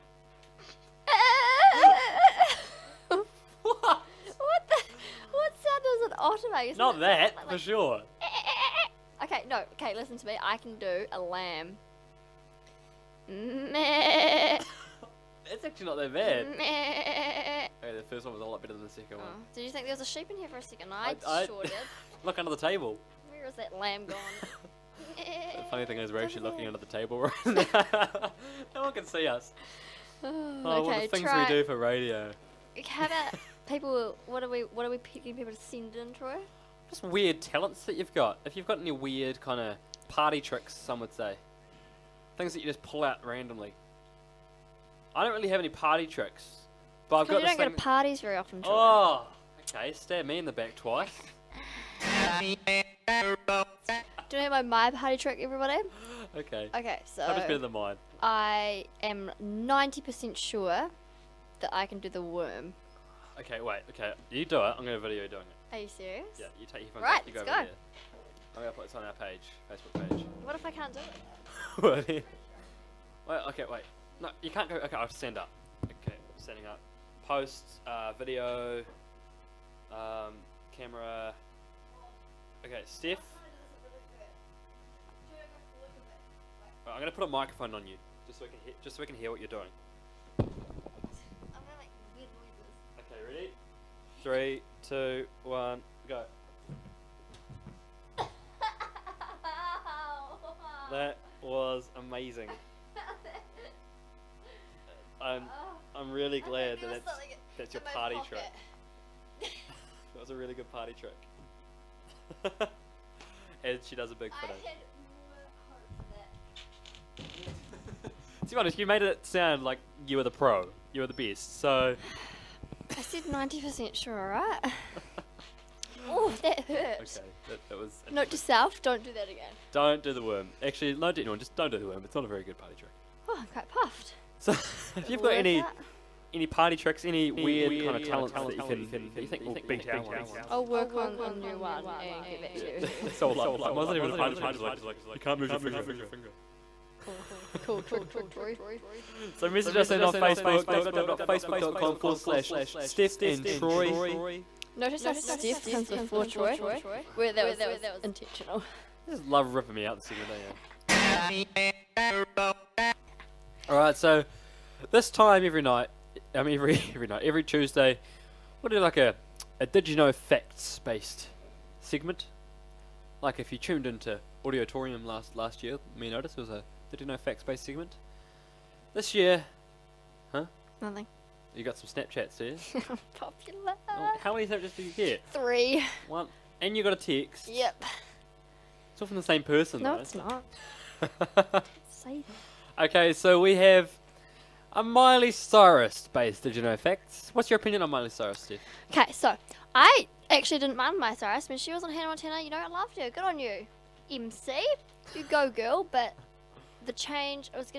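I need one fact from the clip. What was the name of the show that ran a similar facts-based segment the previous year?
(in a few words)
Auditorium.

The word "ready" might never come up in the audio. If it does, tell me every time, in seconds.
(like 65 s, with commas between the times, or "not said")
93 s.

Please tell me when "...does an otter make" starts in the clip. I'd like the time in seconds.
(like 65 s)
5 s.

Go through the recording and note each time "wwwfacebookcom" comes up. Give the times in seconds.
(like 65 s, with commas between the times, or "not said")
150 s.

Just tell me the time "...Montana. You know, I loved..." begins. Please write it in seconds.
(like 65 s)
202 s.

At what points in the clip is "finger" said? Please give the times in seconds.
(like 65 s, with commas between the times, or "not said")
145 s.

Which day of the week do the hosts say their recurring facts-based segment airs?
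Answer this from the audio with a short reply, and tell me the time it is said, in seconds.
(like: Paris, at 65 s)
Tuesday, at 167 s.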